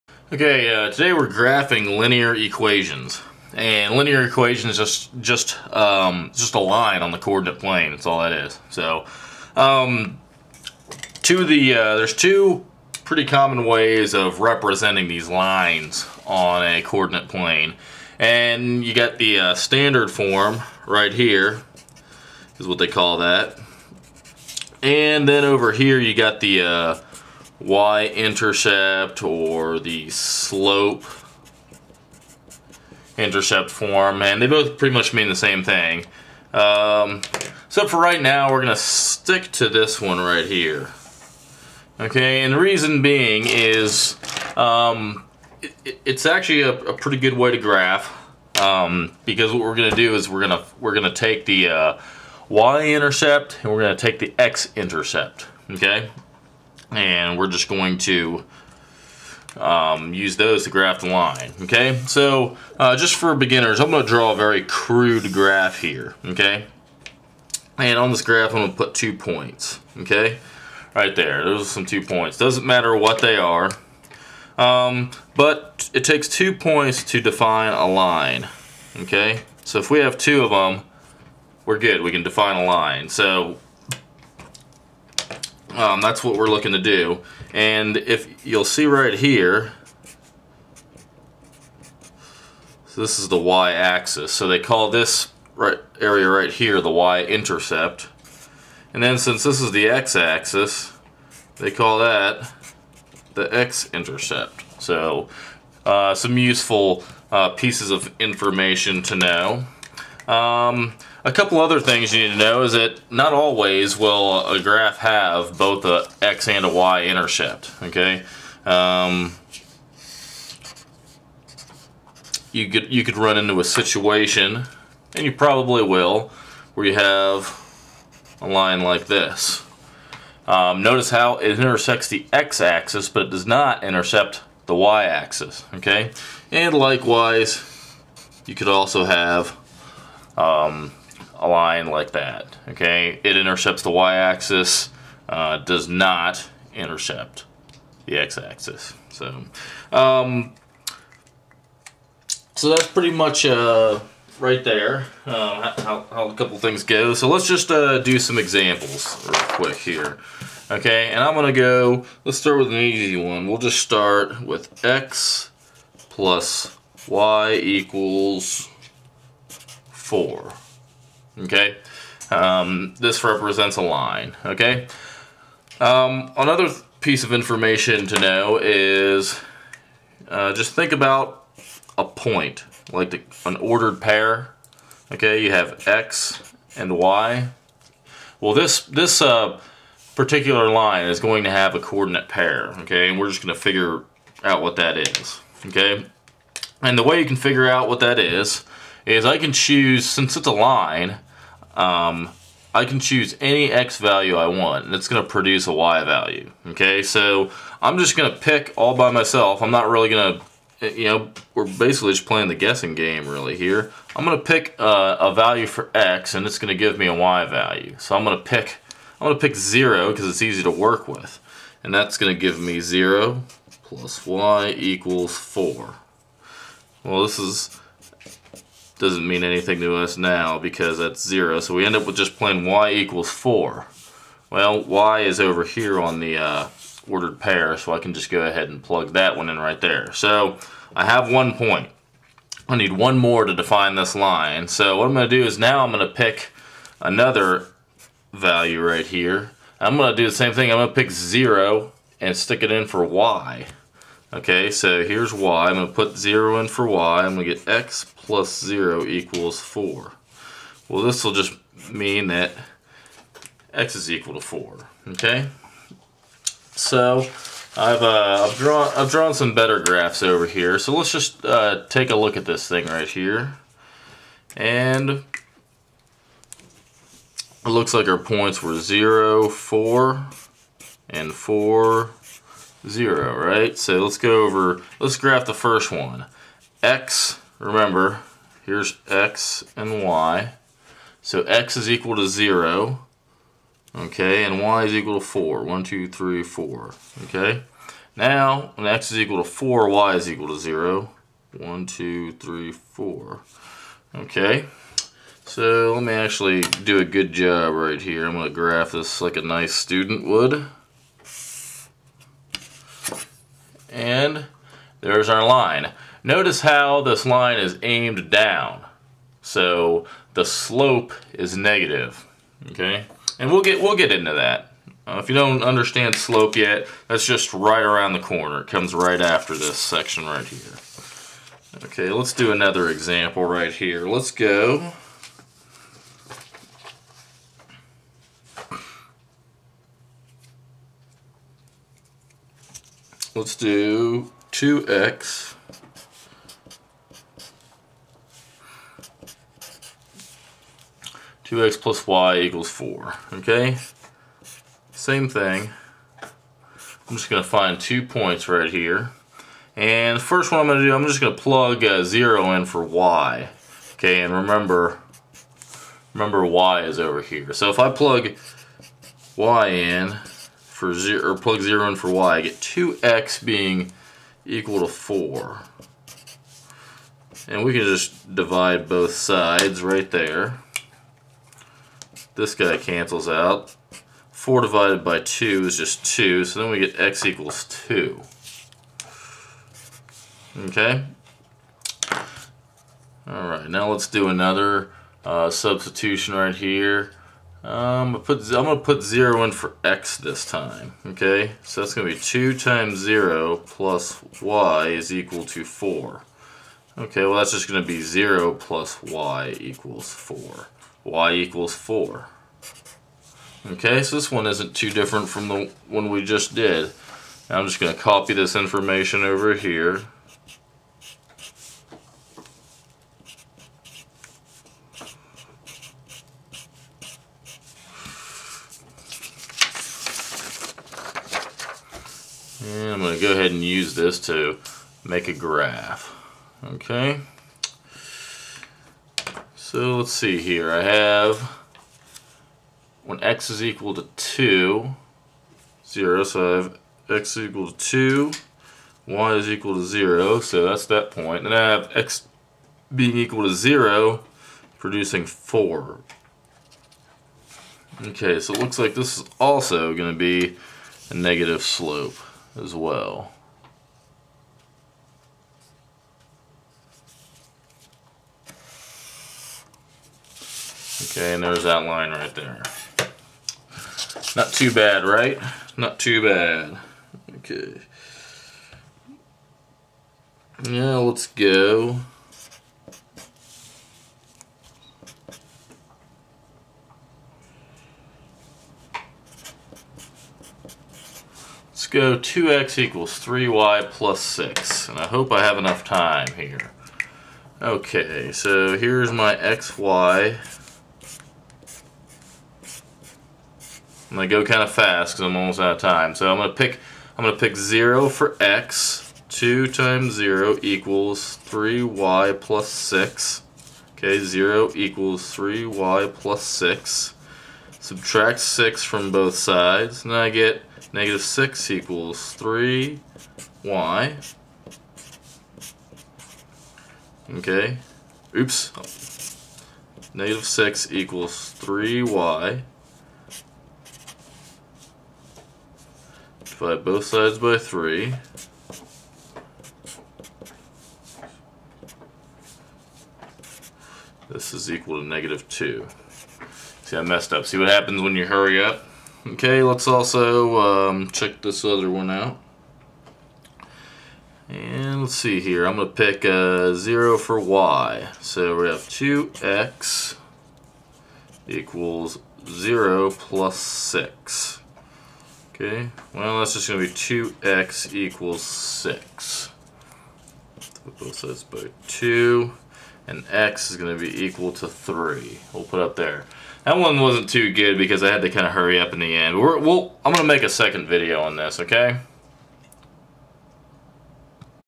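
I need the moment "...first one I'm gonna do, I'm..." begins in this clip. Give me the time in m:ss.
6:00.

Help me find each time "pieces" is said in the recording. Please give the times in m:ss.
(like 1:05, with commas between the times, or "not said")
1:47, 2:57.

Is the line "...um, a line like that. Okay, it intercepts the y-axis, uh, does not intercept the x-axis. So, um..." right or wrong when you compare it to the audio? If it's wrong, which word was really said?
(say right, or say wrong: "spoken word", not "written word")
right.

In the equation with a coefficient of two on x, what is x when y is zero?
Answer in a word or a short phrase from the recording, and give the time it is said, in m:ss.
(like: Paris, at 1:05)
2, at 6:26.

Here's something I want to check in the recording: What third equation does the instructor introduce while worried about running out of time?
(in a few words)
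2x = 3y + 6.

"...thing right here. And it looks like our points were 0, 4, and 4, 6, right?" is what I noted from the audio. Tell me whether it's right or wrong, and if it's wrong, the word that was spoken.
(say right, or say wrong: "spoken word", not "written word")
wrong: "0", not "6".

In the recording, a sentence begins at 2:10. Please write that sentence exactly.
Um, notice how it intersects the x-axis, but it does not intercept the y-axis.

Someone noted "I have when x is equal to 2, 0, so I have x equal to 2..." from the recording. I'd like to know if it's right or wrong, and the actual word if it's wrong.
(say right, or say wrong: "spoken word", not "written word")
right.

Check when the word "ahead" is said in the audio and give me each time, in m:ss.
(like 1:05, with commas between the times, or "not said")
3:58, 7:13.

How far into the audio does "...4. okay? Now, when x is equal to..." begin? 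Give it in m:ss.
4:55.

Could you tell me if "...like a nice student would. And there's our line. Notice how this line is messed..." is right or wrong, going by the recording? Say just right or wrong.
wrong.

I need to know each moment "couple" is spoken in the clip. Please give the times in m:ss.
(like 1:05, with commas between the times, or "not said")
1:51, 2:36.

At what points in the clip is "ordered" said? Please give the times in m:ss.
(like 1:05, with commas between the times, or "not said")
3:03, 3:57.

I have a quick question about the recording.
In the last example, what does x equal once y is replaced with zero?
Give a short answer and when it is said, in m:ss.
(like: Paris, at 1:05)
3, at 9:33.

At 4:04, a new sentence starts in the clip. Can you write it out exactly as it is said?
So what I'm going to do is now I'm going to pick another value right here.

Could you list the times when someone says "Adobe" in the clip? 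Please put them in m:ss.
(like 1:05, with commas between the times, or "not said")
not said.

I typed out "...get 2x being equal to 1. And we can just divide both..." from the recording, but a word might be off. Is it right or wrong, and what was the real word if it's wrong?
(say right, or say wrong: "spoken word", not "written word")
wrong: "4", not "1".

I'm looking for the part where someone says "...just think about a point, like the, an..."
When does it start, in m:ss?
3:00.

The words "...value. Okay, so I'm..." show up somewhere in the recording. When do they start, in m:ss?
3:26.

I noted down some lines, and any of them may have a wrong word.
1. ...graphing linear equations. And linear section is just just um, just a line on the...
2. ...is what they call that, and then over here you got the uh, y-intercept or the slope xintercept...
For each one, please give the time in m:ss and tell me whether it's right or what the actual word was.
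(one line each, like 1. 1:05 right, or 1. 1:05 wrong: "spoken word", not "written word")
1. 0:01 wrong: "equation", not "section"
2. 0:22 wrong: "intercept", not "xintercept".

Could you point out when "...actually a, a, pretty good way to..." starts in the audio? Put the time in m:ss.
0:46.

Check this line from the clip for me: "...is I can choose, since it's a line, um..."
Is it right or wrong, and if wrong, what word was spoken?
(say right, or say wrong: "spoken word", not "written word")
right.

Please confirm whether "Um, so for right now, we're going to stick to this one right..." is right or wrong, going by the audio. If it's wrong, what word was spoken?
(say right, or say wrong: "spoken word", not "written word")
right.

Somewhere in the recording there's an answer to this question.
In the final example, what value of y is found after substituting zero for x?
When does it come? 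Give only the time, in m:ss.
9:05.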